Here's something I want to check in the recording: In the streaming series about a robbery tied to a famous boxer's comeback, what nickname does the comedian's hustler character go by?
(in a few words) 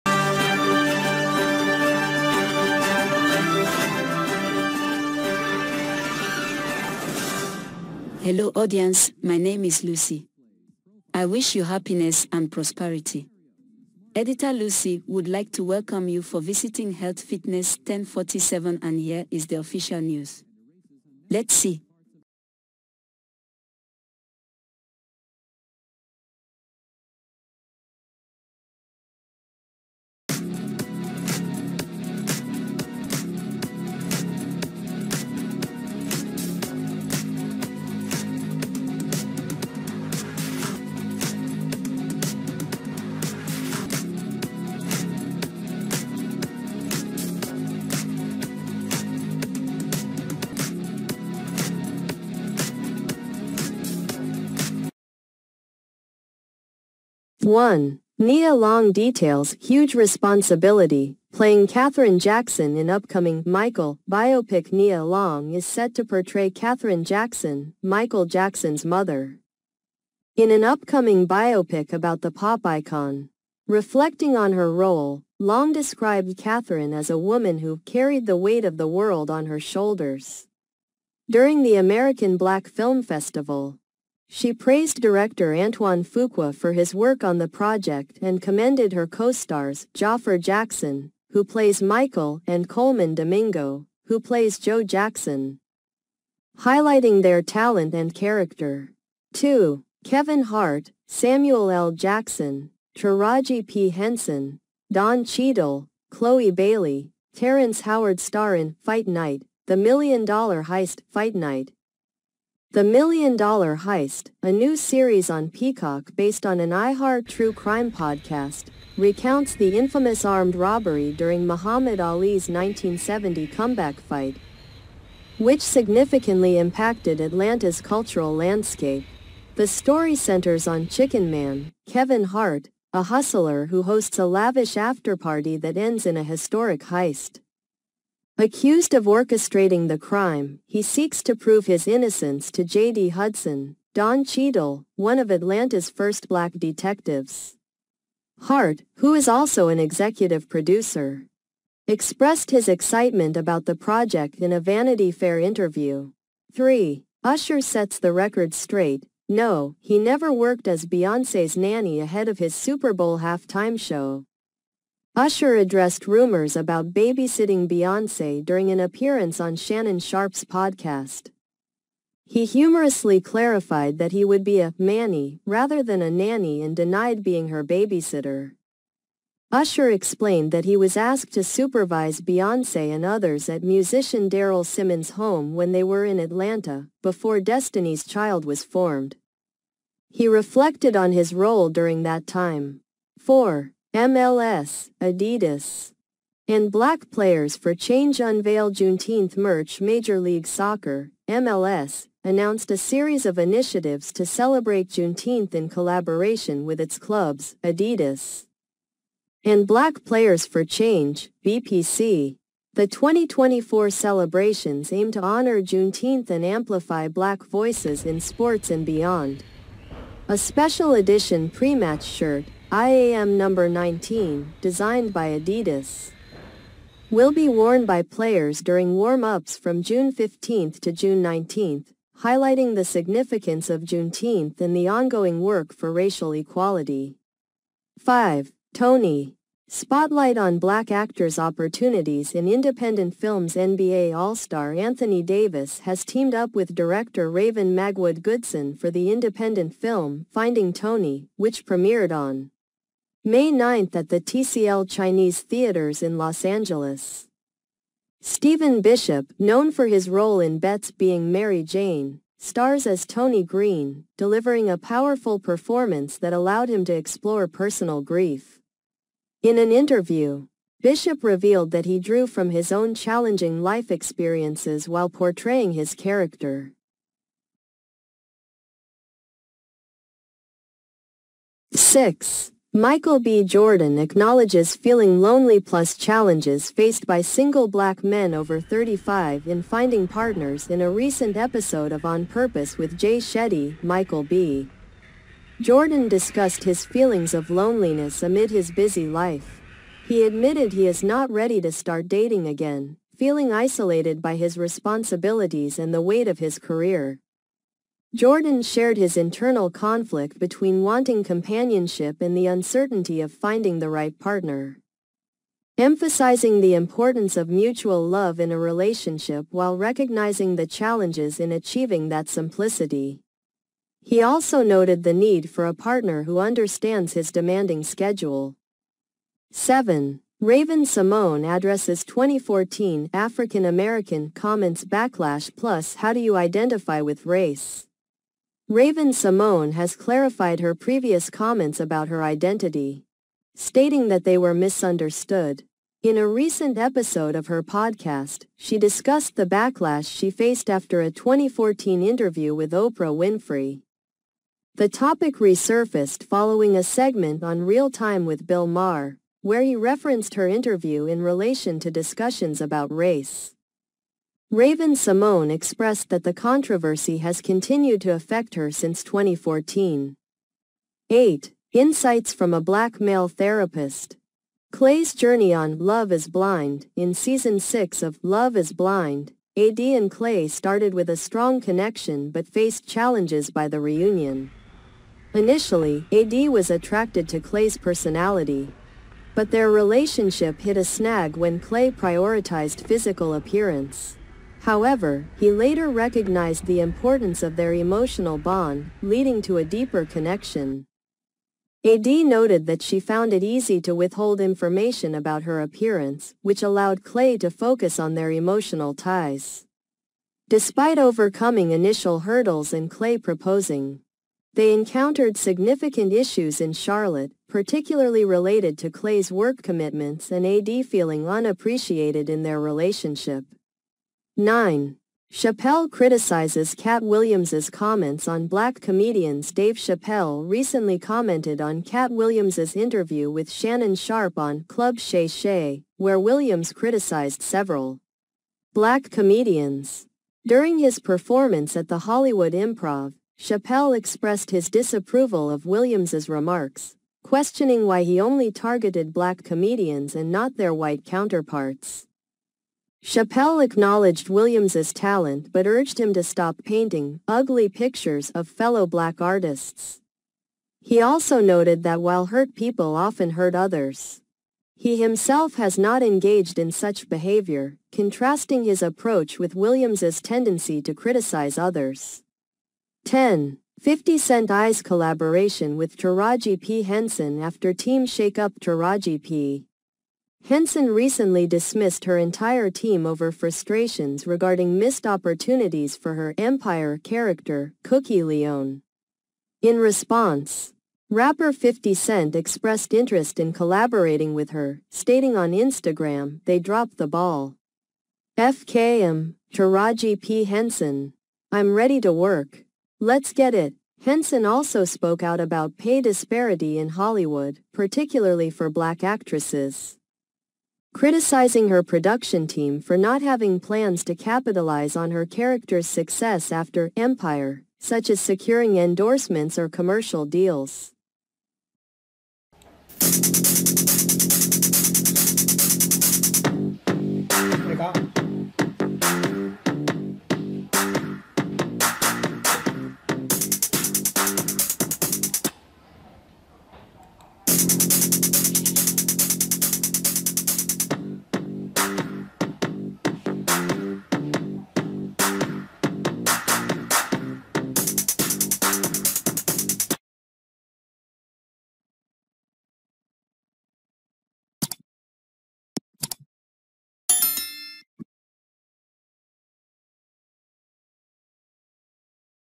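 Chicken Man.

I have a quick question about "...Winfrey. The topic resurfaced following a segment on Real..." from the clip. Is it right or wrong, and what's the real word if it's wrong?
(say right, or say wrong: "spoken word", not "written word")
right.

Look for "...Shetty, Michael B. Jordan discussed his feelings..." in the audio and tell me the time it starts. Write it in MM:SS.
04:53.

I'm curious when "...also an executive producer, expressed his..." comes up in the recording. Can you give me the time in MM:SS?
02:29.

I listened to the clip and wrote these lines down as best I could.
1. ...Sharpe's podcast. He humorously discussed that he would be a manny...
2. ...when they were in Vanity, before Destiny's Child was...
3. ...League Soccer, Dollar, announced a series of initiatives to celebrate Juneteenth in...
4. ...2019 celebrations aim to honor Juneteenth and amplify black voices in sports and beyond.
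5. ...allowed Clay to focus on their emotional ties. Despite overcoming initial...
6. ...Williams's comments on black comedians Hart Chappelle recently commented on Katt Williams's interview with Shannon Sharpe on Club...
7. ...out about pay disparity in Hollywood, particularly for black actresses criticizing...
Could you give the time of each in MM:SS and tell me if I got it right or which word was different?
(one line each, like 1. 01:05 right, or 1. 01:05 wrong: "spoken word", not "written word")
1. 02:49 wrong: "clarified", not "discussed"
2. 03:05 wrong: "Atlanta", not "Vanity"
3. 03:20 wrong: "MLS", not "Dollar"
4. 03:32 wrong: "2024", not "2019"
5. 06:46 right
6. 07:07 wrong: "Dave", not "Hart"
7. 08:25 right.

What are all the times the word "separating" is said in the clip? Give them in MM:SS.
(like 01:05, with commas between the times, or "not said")
not said.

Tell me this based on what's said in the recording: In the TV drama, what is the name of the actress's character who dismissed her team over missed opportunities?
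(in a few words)
Cookie Lyon.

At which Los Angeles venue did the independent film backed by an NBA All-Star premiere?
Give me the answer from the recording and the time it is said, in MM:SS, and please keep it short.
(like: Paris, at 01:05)
TCL Chinese Theaters, at 04:14.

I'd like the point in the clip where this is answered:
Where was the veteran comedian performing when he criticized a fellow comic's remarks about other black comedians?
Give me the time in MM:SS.
07:21.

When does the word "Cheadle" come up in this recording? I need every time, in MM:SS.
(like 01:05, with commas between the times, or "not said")
01:45, 02:24.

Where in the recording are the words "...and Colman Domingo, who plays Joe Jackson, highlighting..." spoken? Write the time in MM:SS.
01:32.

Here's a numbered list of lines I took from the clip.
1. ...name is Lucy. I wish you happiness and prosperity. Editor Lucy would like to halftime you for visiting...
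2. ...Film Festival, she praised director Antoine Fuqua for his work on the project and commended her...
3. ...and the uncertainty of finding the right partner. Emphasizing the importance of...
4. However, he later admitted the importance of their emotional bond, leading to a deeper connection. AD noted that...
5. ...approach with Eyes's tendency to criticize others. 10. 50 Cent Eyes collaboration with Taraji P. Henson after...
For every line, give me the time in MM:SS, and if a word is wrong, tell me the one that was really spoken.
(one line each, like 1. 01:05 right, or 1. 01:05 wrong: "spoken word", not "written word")
1. 00:09 wrong: "welcome", not "halftime"
2. 01:22 right
3. 05:12 right
4. 06:34 wrong: "recognized", not "admitted"
5. 07:48 wrong: "Williams", not "Eyes".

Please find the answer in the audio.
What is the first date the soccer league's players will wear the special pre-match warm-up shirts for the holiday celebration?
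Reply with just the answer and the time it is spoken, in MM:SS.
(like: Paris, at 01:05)
June 15, at 03:49.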